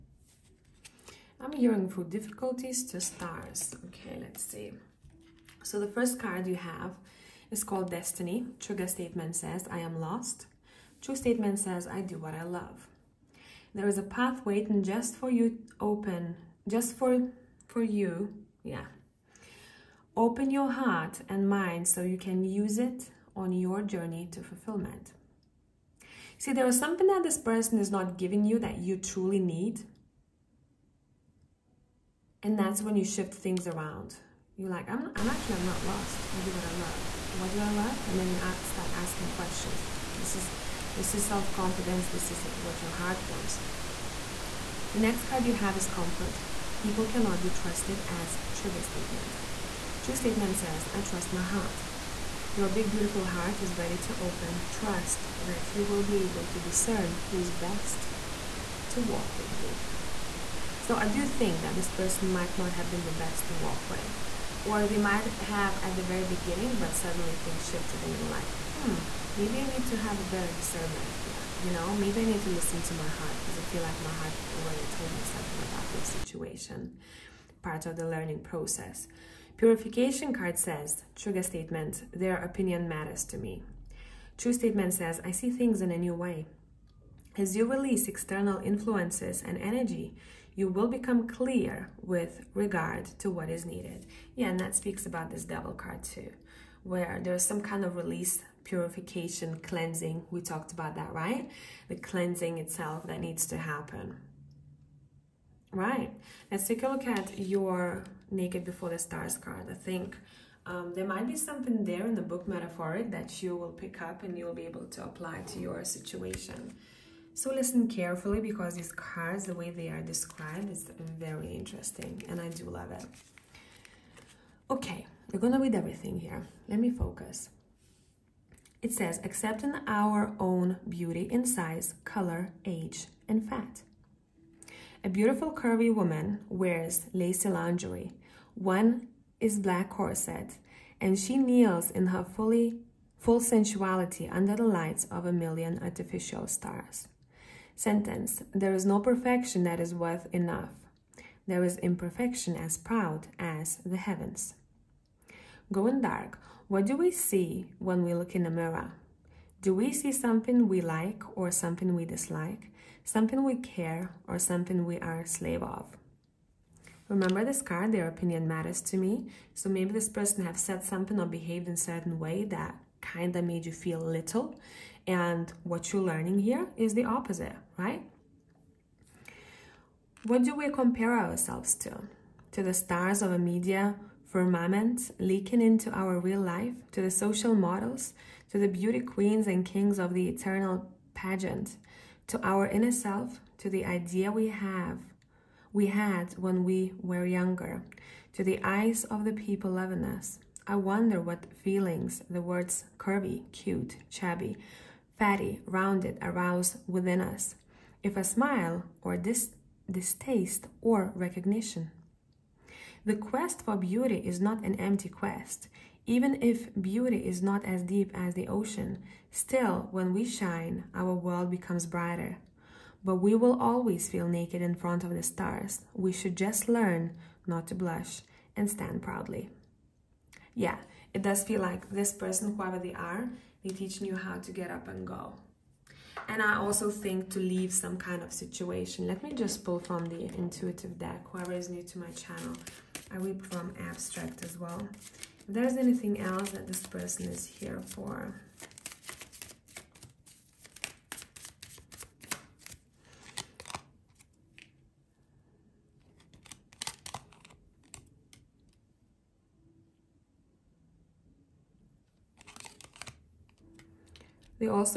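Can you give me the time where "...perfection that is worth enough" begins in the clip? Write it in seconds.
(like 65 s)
148 s.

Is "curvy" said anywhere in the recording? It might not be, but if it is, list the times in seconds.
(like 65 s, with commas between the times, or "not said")
135 s, 202 s.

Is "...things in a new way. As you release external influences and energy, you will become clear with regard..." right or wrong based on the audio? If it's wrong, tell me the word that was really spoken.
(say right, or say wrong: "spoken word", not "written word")
right.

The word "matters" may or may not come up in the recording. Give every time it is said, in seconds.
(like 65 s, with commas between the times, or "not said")
82 s, 168 s.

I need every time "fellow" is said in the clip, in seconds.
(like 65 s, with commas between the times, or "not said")
not said.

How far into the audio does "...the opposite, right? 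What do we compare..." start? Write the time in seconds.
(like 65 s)
176 s.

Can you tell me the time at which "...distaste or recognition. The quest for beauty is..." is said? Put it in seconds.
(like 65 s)
209 s.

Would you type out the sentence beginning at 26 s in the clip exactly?
See, there is something that this person is not giving you that you truly need.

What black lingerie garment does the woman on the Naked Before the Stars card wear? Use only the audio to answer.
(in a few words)
Corset.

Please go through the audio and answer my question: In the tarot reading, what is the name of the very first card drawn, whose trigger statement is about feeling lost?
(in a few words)
Destiny.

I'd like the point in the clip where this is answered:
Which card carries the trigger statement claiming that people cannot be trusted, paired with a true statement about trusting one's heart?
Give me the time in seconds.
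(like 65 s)
45 s.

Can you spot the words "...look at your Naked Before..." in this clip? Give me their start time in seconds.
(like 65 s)
106 s.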